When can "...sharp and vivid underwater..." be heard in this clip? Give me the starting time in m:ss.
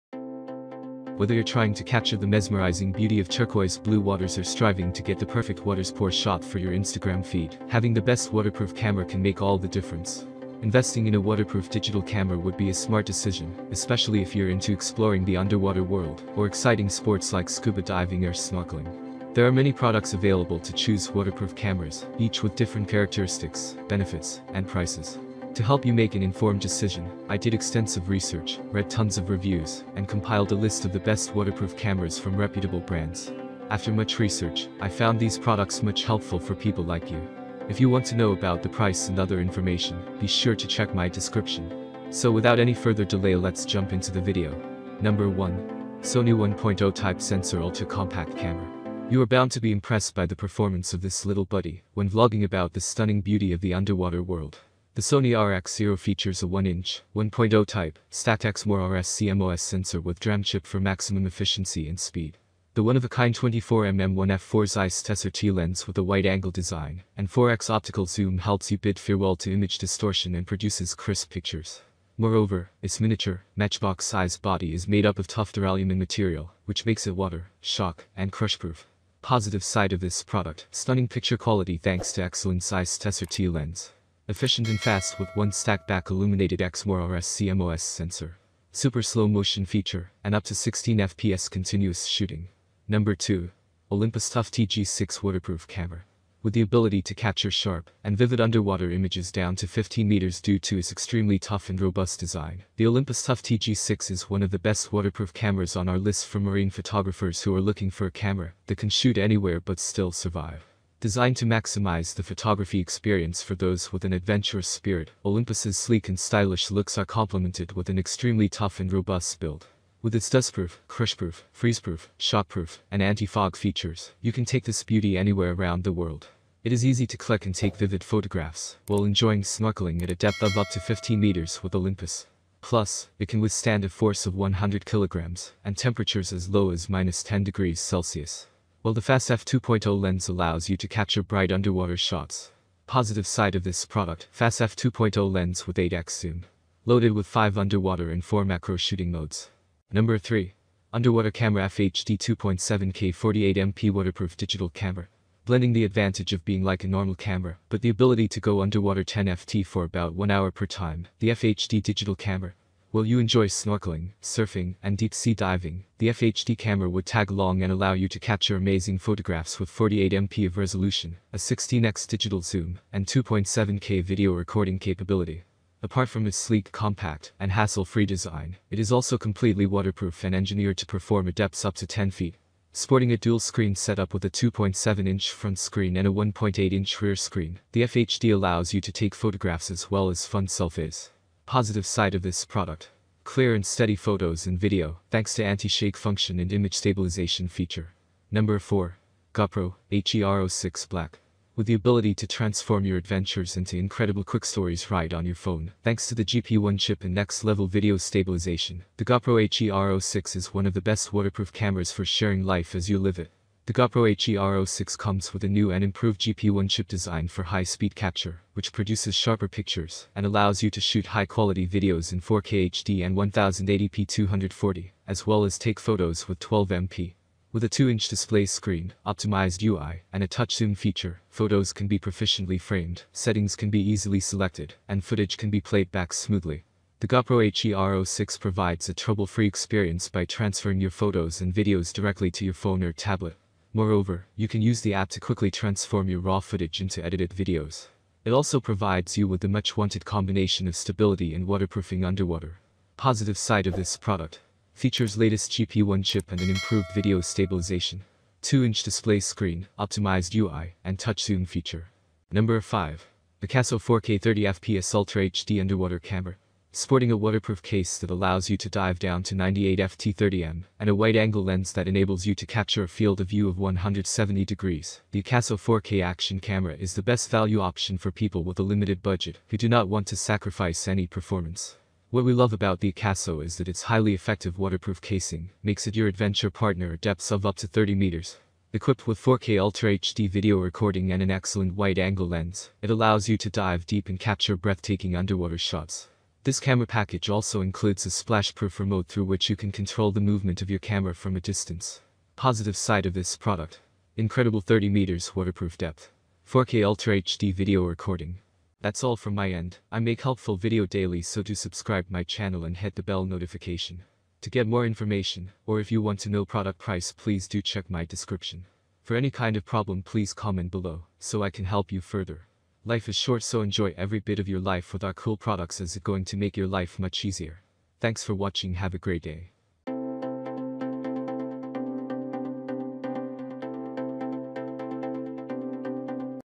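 1:37.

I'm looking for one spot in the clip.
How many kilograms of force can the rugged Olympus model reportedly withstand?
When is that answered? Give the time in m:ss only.
2:14.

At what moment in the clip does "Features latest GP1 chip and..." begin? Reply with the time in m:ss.
4:14.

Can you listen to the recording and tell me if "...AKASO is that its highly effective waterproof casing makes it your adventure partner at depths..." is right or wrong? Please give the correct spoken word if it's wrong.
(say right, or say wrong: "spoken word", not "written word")
right.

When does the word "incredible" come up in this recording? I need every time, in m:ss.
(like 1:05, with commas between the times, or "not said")
3:23, 5:04.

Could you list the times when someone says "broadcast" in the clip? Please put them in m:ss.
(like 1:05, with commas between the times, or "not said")
not said.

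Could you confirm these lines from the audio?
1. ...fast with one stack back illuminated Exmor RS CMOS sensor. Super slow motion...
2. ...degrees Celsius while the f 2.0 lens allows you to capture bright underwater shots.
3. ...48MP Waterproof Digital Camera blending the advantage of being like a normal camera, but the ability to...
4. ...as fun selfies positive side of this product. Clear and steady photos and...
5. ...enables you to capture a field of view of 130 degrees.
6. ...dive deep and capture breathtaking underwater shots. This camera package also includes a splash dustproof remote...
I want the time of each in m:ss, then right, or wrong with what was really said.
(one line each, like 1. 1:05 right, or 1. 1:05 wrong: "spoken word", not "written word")
1. 1:24 right
2. 2:17 right
3. 2:33 right
4. 3:10 right
5. 4:31 wrong: "170", not "130"
6. 4:53 wrong: "proof", not "dustproof".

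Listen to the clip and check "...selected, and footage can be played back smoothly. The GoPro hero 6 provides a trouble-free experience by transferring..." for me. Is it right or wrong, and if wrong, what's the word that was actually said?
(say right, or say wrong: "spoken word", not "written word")
right.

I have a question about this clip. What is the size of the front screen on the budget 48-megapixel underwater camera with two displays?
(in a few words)
2.7-inch.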